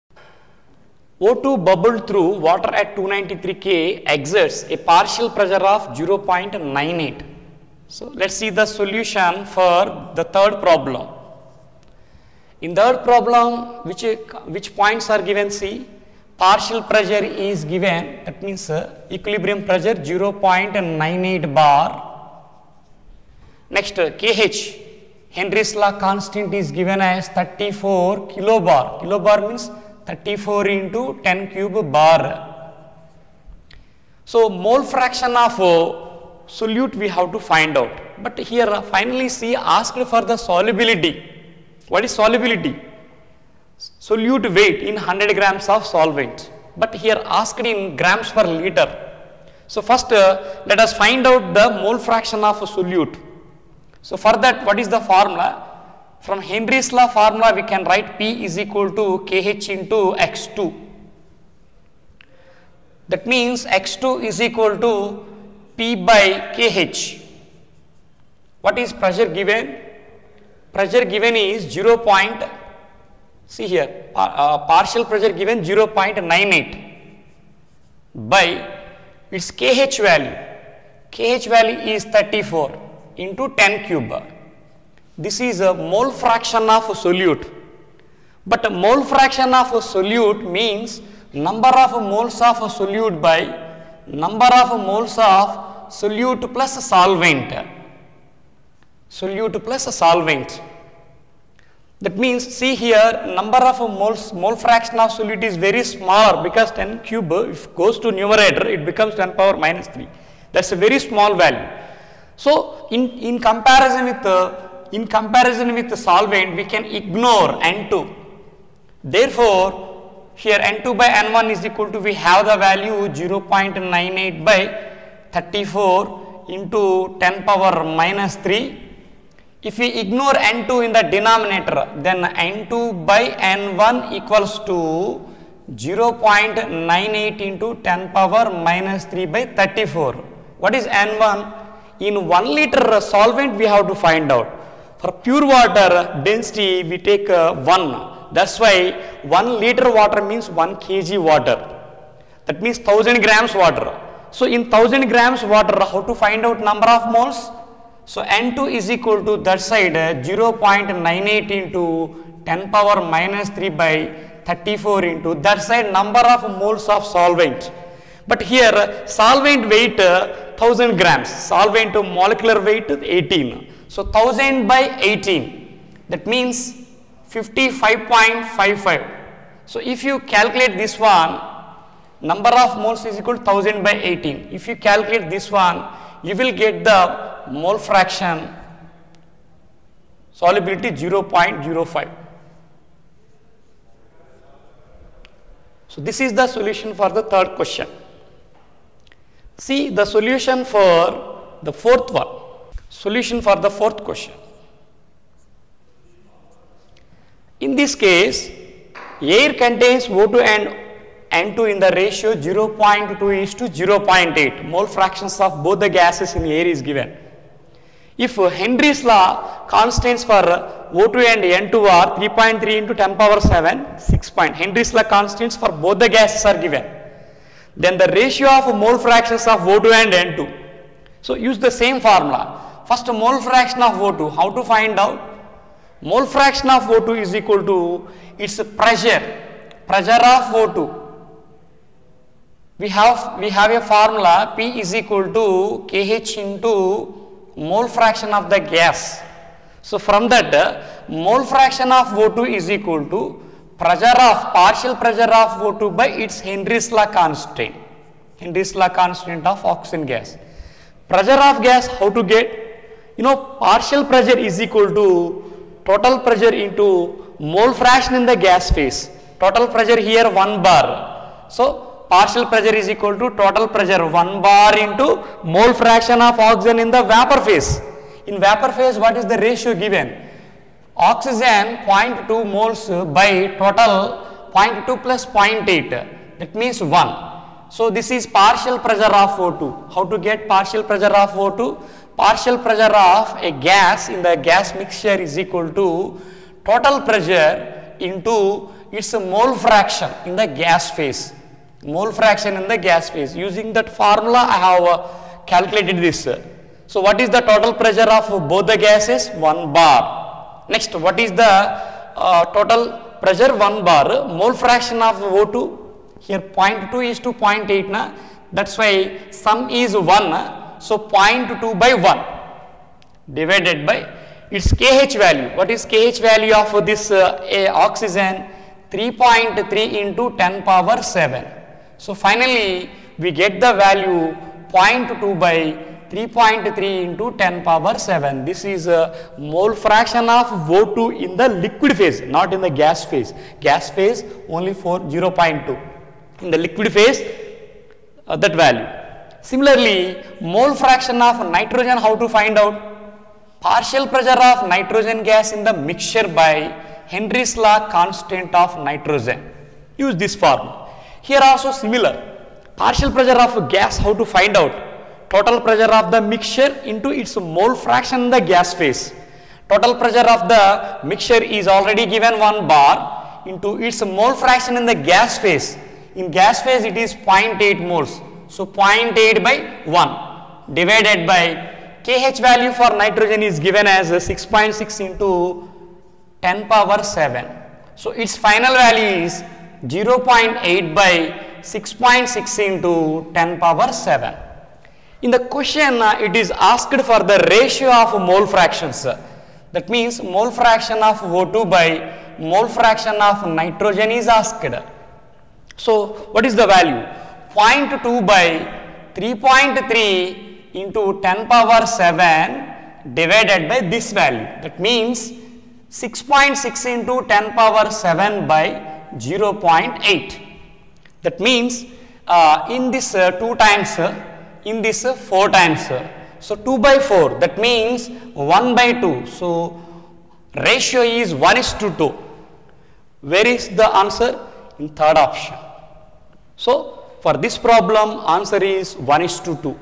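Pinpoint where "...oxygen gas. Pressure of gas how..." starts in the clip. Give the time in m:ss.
4:19.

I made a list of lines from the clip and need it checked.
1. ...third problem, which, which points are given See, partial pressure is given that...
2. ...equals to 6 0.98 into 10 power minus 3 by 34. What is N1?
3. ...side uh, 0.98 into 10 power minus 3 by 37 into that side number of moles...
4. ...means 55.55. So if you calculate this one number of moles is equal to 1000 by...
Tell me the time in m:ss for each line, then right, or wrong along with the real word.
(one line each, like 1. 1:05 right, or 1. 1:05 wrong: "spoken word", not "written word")
1. 0:12 right
2. 2:14 wrong: "0", not "6"
3. 2:39 wrong: "34", not "37"
4. 2:56 right.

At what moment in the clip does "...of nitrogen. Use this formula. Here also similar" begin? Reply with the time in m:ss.
5:58.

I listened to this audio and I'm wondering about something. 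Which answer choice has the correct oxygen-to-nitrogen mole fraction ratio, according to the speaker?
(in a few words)
third option.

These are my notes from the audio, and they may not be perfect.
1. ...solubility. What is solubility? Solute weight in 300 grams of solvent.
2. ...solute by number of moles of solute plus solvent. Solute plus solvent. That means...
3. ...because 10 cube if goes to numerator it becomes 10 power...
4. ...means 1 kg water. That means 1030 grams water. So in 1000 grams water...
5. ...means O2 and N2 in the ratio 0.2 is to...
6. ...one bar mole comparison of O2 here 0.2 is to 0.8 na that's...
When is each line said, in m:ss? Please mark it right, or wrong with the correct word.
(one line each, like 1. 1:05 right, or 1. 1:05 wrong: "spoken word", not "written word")
1. 0:40 wrong: "100", not "300"
2. 1:32 right
3. 1:46 right
4. 2:30 wrong: "1000", not "1030"
5. 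3:29 wrong: "contains", not "means"
6. 5:13 wrong: "fraction", not "comparison".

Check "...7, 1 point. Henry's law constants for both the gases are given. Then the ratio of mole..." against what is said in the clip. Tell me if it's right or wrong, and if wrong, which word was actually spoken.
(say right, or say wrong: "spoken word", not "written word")
wrong: "6", not "1".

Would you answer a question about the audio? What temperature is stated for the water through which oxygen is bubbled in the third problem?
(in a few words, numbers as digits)
293 K.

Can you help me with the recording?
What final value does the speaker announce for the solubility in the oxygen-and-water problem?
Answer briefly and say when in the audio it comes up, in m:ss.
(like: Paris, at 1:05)
0.05, at 3:10.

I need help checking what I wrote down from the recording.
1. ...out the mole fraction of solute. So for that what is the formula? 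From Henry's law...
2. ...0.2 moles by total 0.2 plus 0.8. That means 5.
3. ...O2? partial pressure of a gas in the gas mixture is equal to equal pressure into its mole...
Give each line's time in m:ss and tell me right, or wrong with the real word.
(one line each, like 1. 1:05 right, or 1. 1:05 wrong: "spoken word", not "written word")
1. 0:51 right
2. 4:42 wrong: "1", not "5"
3. 4:51 wrong: "total", not "equal".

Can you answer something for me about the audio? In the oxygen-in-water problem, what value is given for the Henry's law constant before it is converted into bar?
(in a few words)
34 kilobar.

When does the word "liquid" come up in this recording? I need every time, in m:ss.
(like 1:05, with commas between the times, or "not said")
5:41, 5:46.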